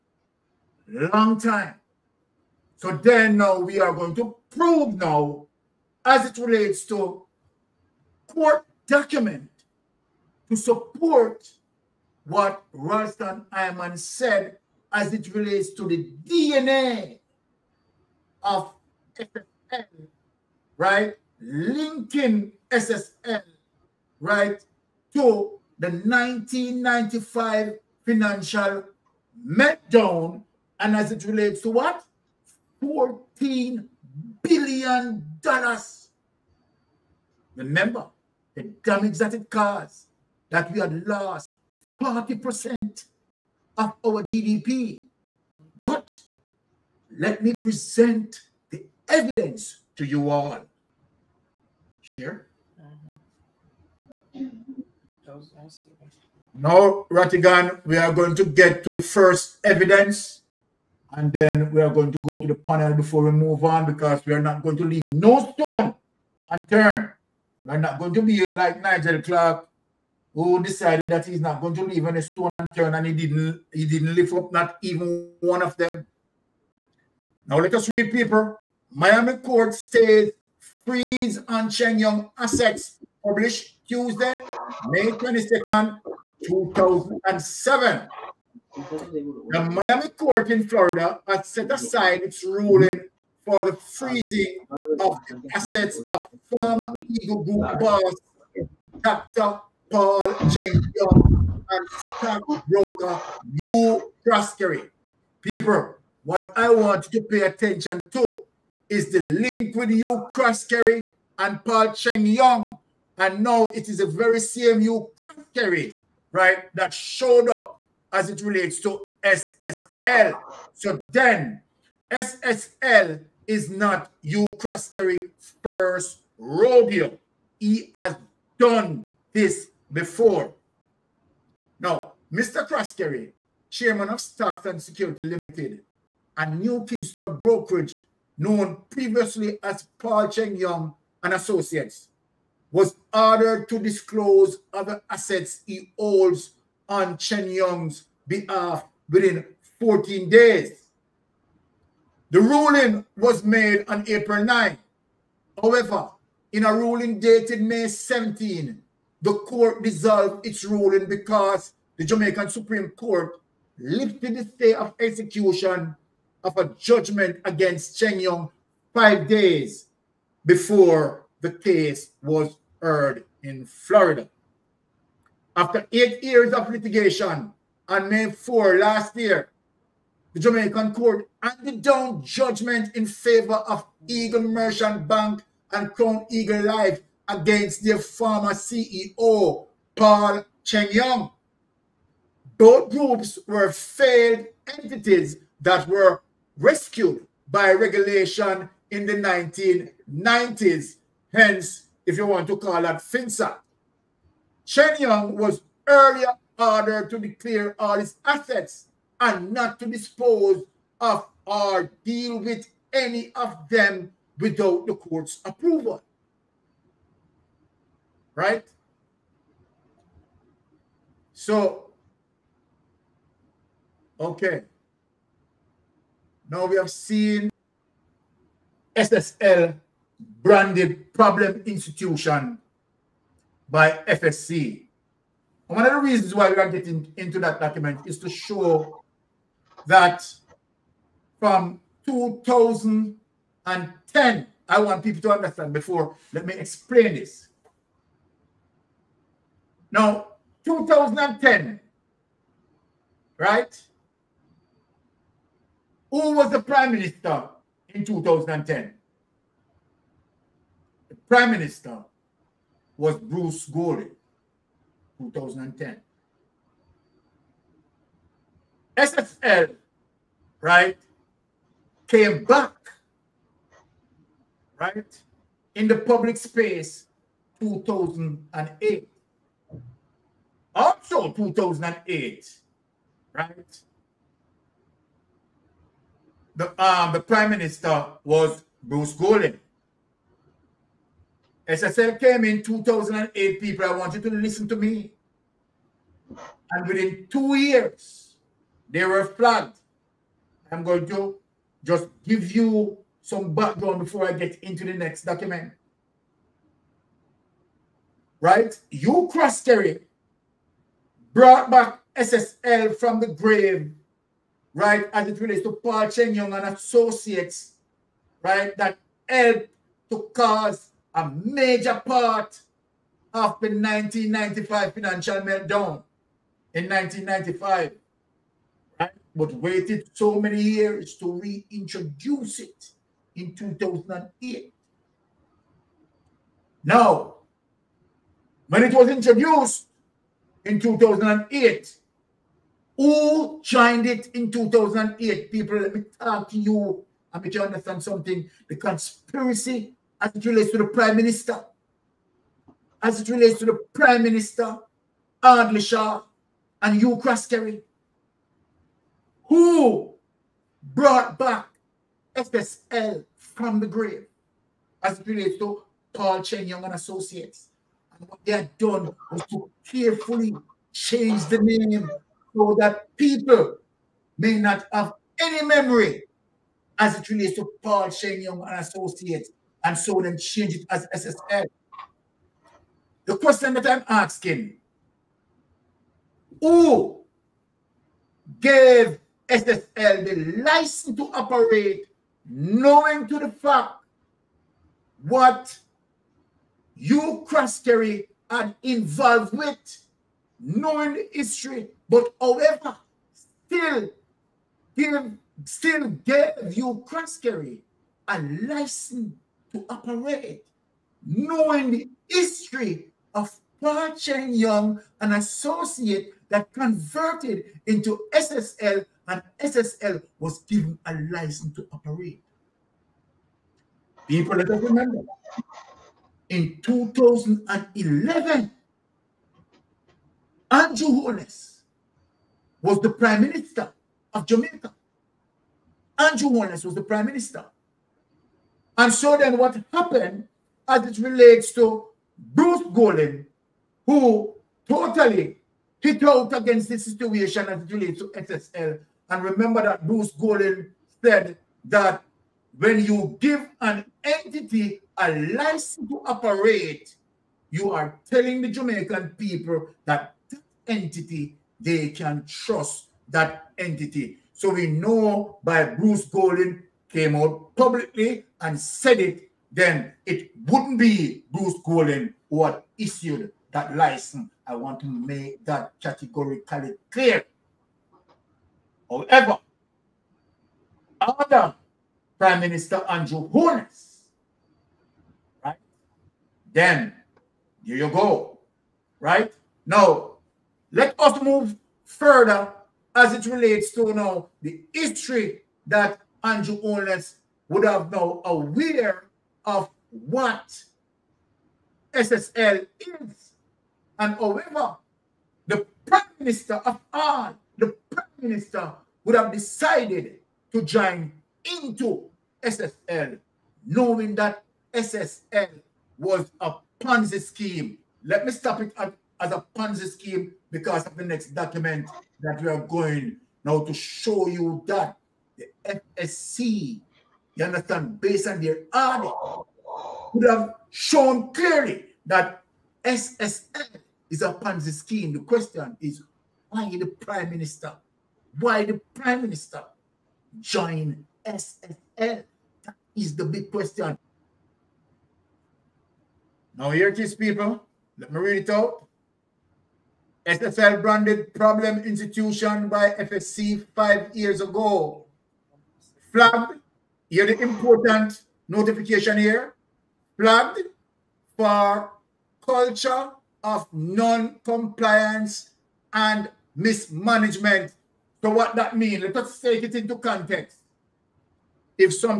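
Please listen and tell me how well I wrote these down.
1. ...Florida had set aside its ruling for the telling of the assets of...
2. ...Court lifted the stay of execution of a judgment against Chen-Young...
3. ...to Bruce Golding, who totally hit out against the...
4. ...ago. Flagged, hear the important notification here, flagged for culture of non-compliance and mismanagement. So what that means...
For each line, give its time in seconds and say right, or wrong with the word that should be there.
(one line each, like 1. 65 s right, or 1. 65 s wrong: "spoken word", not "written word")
1. 90 s wrong: "freezing", not "telling"
2. 162 s right
3. 441 s right
4. 554 s right.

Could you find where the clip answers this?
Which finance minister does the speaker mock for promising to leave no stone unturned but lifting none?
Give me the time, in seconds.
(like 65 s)
68 s.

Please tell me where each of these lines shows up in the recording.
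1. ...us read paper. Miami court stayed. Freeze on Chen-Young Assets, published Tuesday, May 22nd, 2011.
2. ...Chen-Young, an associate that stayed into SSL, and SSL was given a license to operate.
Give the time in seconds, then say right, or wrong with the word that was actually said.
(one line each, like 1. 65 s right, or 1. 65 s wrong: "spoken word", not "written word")
1. 77 s wrong: "2007", not "2011"
2. 414 s wrong: "converted", not "stayed".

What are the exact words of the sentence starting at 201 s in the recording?
Hence, if you want to call that FINSAC.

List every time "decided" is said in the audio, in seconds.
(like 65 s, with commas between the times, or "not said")
70 s, 509 s.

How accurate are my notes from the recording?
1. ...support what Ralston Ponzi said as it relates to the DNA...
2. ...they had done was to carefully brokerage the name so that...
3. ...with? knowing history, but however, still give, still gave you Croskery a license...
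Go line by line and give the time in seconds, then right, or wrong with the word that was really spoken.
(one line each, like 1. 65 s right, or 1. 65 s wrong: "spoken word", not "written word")
1. 10 s wrong: "Hyman", not "Ponzi"
2. 368 s wrong: "change", not "brokerage"
3. 399 s right.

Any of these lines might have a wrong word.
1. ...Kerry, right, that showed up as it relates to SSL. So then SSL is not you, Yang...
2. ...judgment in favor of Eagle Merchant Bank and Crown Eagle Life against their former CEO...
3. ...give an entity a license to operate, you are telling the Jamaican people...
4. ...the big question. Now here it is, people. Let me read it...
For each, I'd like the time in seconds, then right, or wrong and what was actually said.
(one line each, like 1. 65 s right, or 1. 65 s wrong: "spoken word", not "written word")
1. 115 s wrong: "Croskery", not "Yang"
2. 182 s right
3. 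453 s right
4. 543 s right.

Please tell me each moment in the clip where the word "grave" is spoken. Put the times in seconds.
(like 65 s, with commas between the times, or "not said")
313 s, 363 s.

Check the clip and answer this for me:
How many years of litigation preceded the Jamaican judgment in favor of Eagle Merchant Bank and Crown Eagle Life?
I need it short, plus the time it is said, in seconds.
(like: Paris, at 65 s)
8, at 175 s.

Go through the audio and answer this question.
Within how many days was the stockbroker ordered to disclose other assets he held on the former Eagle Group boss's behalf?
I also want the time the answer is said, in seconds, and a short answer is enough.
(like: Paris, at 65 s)
14, at 149 s.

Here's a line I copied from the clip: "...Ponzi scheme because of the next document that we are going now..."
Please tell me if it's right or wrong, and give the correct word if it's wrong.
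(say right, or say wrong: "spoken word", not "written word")
right.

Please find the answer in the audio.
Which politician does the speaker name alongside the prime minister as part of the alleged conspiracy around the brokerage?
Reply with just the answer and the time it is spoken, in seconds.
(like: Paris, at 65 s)
Audley Shaw, at 355 s.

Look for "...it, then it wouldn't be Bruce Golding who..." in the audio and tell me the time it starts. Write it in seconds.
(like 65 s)
469 s.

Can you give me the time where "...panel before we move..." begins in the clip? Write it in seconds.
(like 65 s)
62 s.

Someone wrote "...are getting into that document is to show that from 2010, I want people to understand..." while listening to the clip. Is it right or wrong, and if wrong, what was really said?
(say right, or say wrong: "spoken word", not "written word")
right.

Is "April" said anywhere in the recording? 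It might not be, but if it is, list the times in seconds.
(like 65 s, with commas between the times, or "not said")
154 s.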